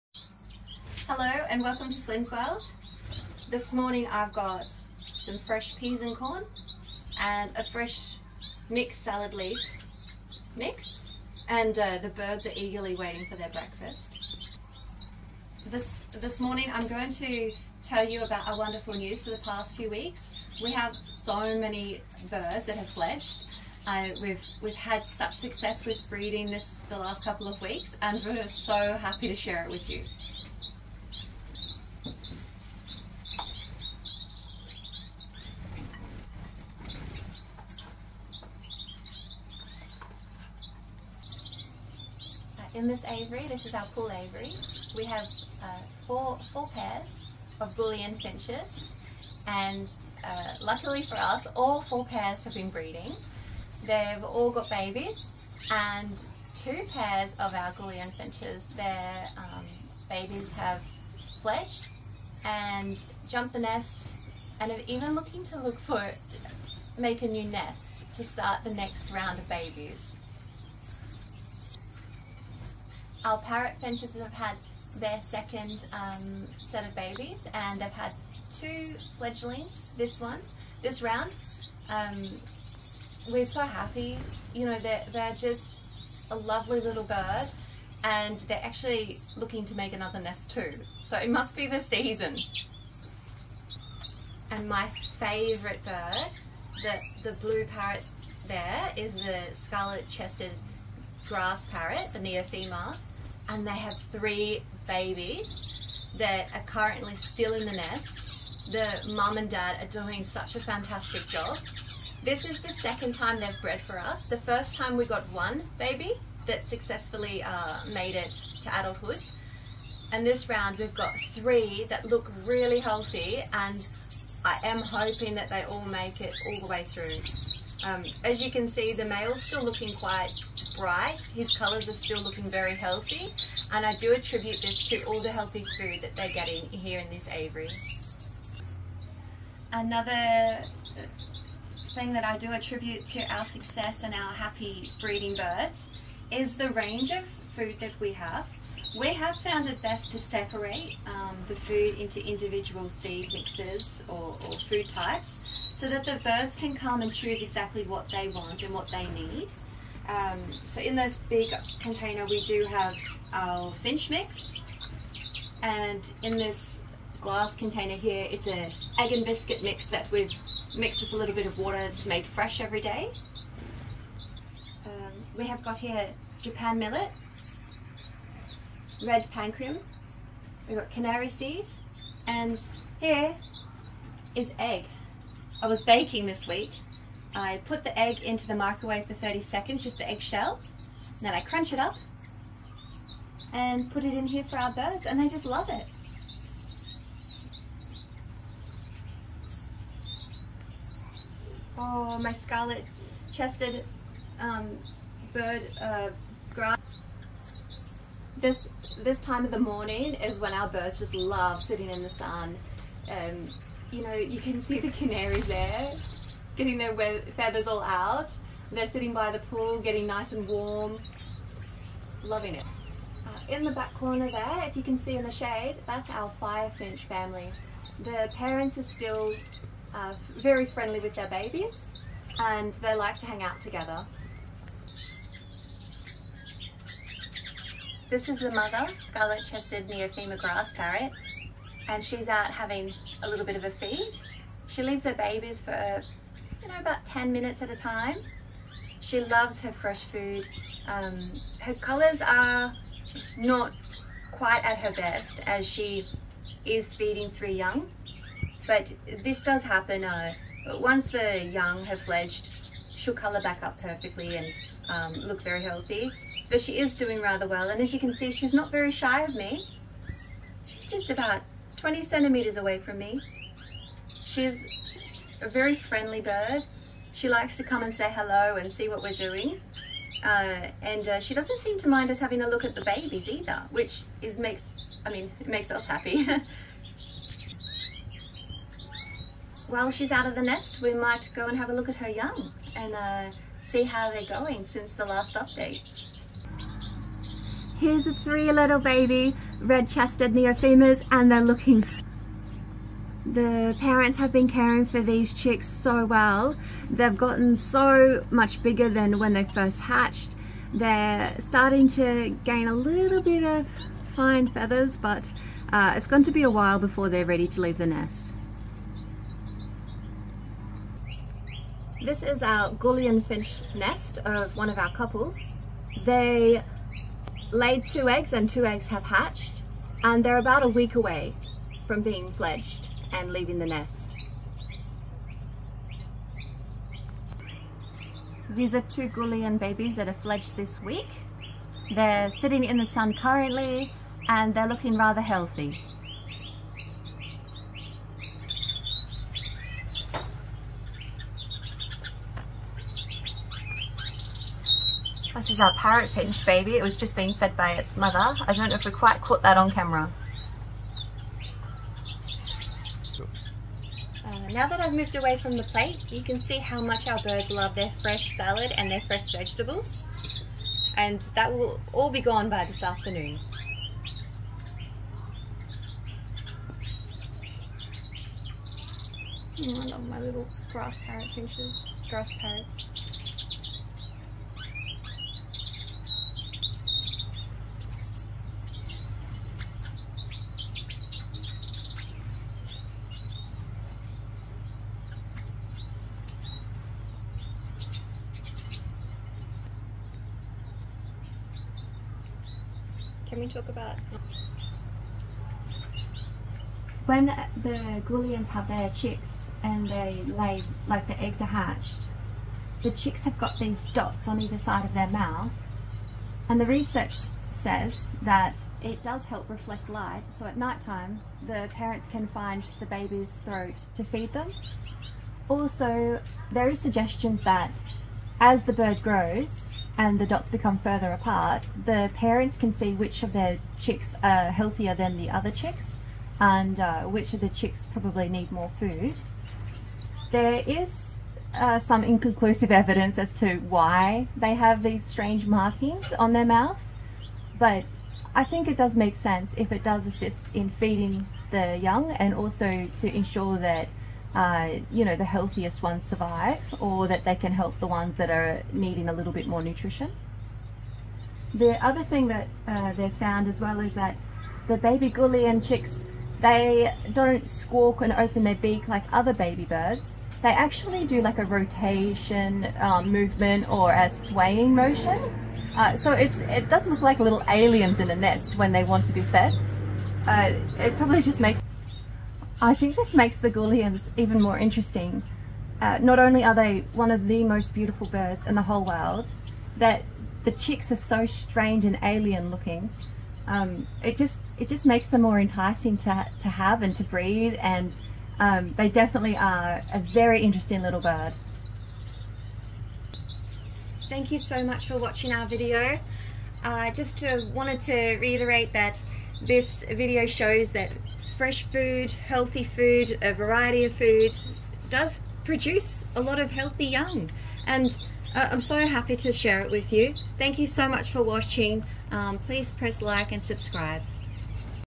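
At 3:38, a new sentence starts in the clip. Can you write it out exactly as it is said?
They're sitting by the pool, getting nice and warm, loving it.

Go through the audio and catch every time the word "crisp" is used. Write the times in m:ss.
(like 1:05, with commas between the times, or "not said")
not said.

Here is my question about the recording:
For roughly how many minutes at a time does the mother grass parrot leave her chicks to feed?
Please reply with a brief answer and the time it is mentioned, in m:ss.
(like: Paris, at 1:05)
10 minutes, at 4:07.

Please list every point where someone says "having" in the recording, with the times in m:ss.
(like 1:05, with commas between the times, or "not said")
4:02, 4:42.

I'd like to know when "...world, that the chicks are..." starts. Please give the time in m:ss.
8:08.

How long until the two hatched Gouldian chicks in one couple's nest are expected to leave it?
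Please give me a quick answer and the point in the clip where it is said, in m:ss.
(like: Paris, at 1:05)
About a week, at 5:30.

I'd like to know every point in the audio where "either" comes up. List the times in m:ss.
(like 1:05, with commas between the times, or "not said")
4:43, 6:54.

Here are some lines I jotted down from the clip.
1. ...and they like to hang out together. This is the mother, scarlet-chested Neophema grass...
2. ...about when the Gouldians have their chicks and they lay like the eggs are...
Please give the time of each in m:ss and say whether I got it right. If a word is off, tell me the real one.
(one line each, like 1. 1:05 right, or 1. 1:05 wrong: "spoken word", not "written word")
1. 3:52 right
2. 6:43 right.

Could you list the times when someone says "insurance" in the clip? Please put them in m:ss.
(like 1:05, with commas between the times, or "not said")
not said.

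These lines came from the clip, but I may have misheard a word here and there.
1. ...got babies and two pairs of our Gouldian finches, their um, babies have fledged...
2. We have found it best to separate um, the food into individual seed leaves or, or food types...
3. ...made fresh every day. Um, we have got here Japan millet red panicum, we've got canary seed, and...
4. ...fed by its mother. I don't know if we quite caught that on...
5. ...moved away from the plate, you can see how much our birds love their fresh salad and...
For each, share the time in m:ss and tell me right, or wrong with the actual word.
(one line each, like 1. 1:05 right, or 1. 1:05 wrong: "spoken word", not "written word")
1. 0:54 right
2. 2:28 wrong: "mixes", not "leaves"
3. 2:52 right
4. 5:57 right
5. 6:04 right.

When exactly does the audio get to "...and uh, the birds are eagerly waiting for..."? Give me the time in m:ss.
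0:11.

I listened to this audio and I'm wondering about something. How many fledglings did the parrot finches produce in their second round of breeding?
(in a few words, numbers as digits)
2.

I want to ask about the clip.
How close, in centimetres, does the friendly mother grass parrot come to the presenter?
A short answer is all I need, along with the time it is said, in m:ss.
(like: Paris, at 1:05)
20 centimetres, at 4:31.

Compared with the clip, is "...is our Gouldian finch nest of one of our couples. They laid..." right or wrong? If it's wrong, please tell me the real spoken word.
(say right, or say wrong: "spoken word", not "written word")
right.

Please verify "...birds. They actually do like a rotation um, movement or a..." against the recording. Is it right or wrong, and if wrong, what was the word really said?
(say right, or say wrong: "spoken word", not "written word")
right.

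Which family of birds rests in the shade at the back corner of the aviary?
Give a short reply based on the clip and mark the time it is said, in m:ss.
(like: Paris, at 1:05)
Firefinch, at 3:46.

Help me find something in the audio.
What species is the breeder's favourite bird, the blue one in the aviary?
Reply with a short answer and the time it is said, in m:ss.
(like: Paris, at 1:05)
Scarlet-chested grass parrot, at 1:39.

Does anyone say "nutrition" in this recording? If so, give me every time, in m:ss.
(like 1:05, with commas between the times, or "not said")
7:39.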